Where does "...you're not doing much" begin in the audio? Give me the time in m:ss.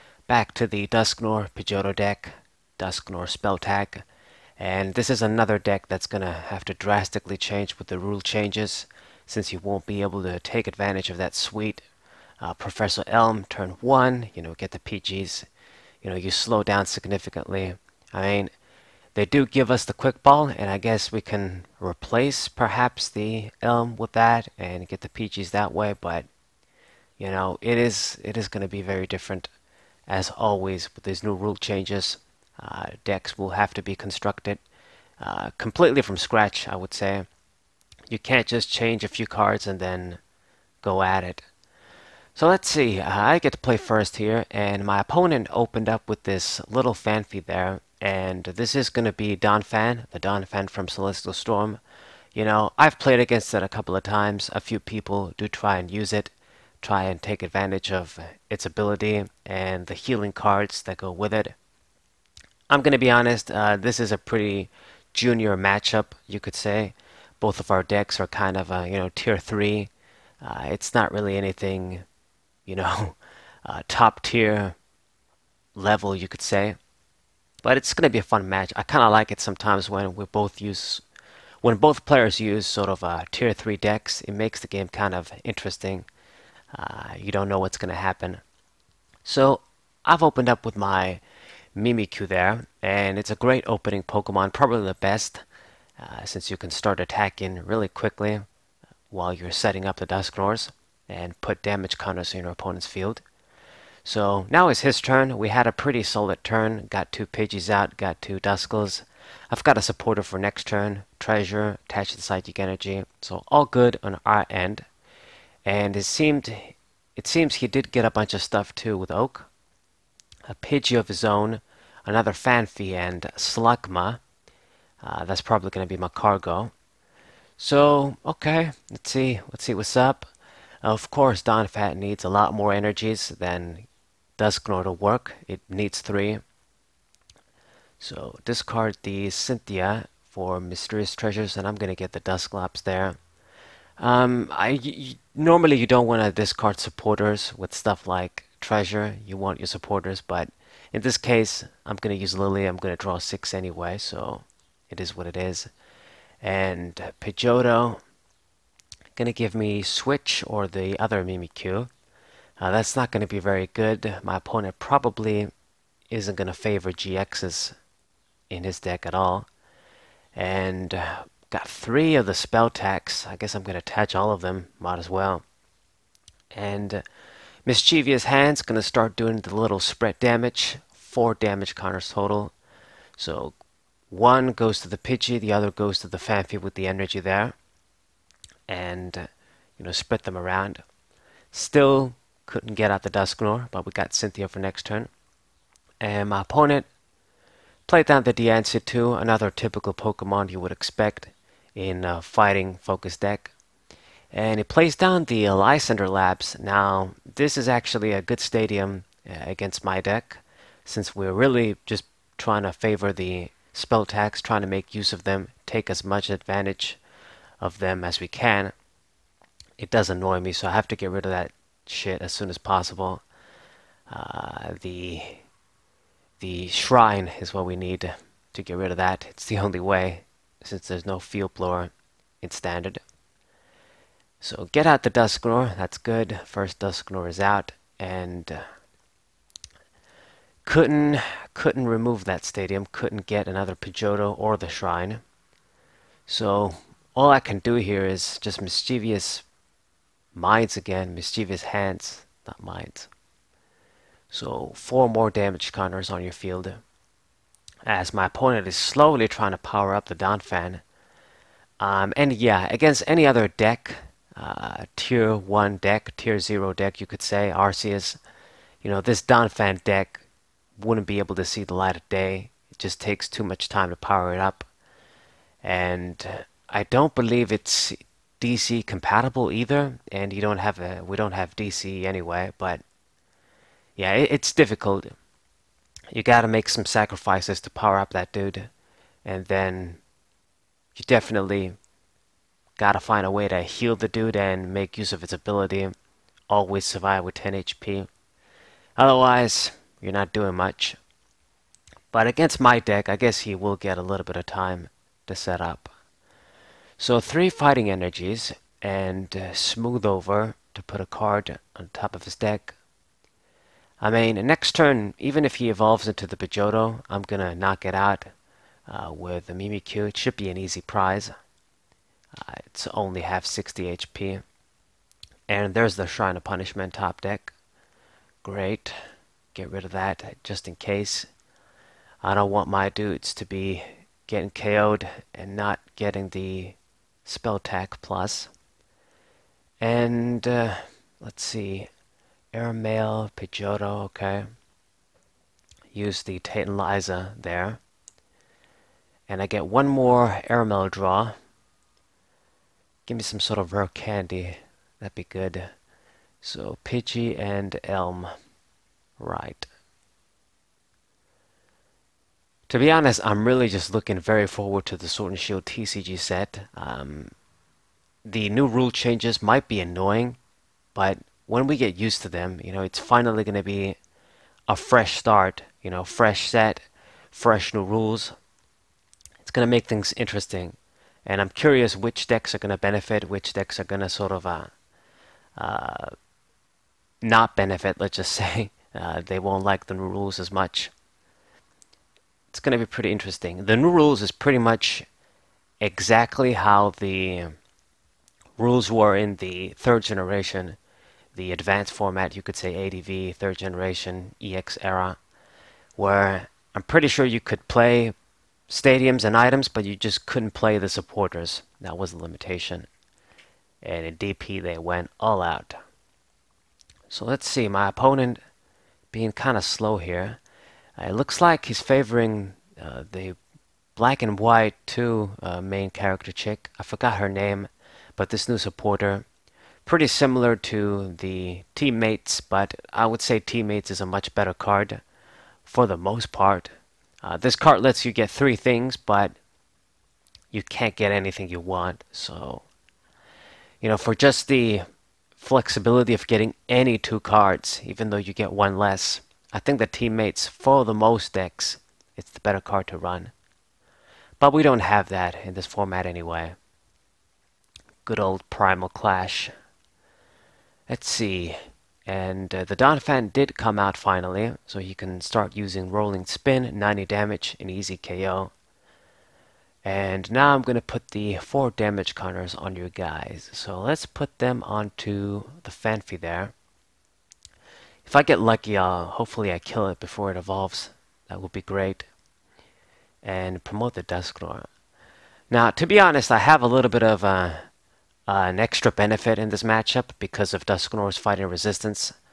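4:59.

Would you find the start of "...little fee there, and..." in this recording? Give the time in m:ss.
0:46.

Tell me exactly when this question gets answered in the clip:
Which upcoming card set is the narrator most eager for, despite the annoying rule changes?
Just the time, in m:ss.
6:05.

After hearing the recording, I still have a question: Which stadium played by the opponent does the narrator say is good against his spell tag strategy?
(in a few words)
Lysandre Labs.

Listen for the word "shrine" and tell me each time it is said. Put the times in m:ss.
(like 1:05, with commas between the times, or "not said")
3:46, 4:04, 5:26.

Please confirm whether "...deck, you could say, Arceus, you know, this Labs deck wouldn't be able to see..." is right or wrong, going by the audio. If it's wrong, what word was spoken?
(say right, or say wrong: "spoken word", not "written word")
wrong: "Donphan", not "Labs".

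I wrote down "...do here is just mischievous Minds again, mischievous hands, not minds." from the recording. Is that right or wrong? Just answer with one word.
right.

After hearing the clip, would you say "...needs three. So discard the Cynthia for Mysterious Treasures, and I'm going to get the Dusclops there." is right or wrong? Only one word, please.
right.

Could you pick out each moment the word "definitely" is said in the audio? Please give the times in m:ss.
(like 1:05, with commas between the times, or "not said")
4:51.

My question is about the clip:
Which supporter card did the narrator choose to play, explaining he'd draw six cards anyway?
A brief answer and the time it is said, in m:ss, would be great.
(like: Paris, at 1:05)
Lillie, at 2:32.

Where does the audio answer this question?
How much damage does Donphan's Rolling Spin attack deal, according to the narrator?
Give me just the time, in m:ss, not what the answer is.
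7:46.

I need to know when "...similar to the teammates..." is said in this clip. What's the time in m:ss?
7:10.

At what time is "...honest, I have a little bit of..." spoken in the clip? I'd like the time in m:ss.
8:05.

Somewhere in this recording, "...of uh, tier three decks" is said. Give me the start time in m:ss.
1:22.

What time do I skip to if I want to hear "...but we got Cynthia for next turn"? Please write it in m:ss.
3:13.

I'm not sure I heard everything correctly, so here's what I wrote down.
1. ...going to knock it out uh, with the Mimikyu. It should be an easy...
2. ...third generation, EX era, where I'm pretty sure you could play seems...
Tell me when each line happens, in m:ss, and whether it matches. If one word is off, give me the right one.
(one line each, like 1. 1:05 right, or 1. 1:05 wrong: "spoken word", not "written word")
1. 5:17 right
2. 6:43 wrong: "stadiums", not "seems".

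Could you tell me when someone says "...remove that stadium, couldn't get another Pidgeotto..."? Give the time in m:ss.
4:01.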